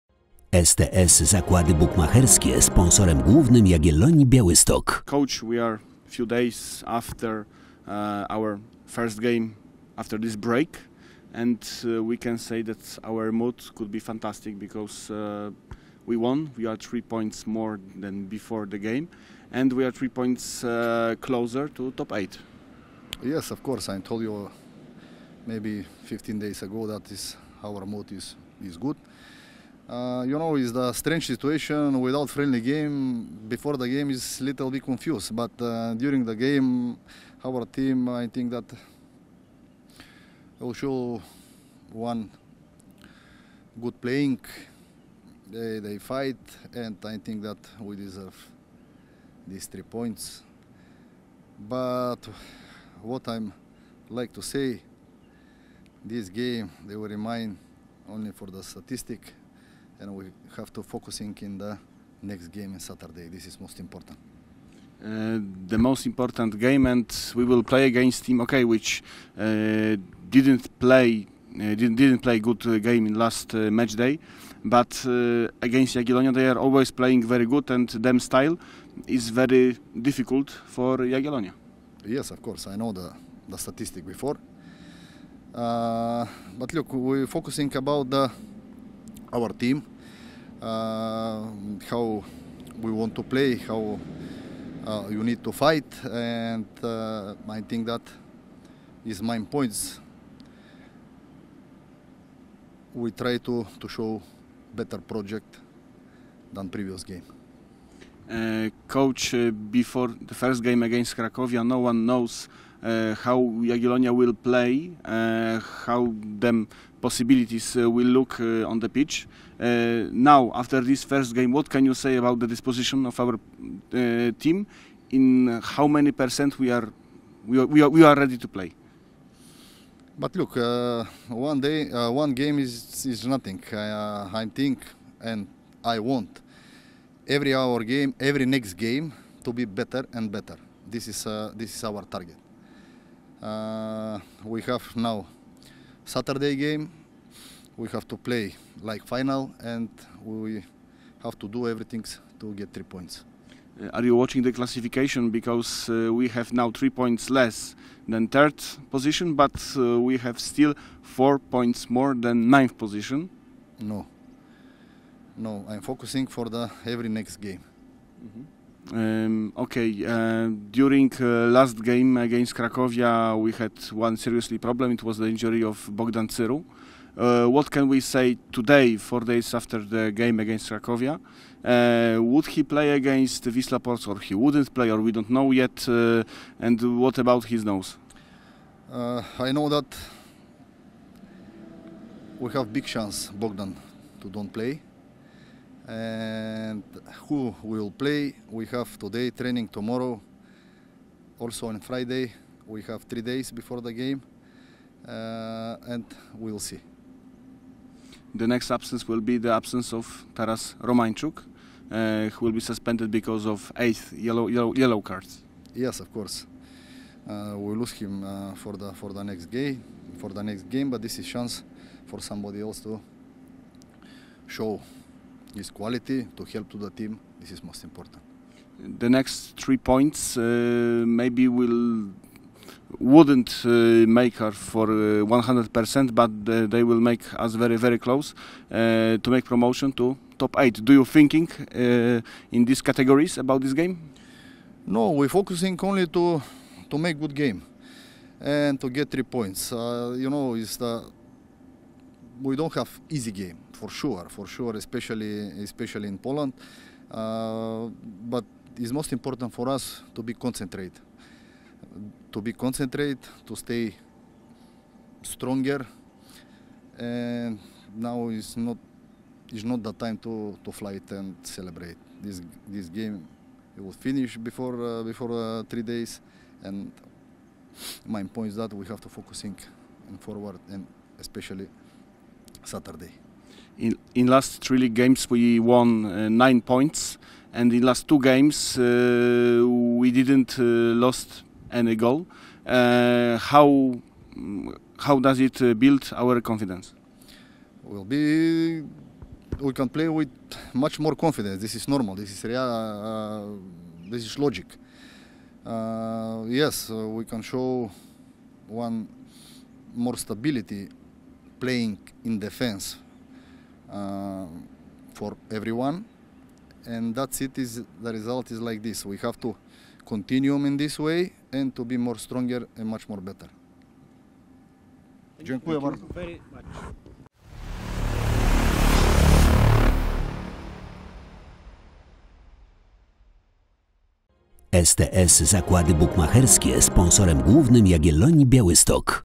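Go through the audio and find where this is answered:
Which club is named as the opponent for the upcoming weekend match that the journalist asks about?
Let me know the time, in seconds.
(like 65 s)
183 s.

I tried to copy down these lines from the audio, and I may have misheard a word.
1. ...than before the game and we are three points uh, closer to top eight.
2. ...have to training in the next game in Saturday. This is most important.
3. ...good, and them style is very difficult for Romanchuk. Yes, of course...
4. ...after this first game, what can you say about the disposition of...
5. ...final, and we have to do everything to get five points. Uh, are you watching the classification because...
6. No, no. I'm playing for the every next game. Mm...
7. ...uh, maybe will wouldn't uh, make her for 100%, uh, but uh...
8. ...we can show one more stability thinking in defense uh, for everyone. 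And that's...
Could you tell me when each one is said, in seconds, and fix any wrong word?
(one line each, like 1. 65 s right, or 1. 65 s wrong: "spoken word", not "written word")
1. 18 s right
2. 60 s wrong: "focusing", not "training"
3. 77 s wrong: "Jagiellonia", not "Romanchuk"
4. 120 s right
5. 149 s wrong: "three", not "five"
6. 163 s wrong: "focusing", not "playing"
7. 230 s right
8. 306 s wrong: "playing", not "thinking".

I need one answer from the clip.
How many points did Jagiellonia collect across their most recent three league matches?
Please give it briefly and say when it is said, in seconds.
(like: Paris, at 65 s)
9 points, at 286 s.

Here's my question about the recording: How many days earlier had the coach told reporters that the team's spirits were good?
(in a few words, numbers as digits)
15 days.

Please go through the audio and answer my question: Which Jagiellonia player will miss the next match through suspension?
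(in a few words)
Taras Romanchuk.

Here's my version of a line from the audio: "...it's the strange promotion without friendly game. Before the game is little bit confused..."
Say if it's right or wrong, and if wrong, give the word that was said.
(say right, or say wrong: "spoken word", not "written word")
wrong: "situation", not "promotion".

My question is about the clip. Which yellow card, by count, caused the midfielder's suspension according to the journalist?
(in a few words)
8th.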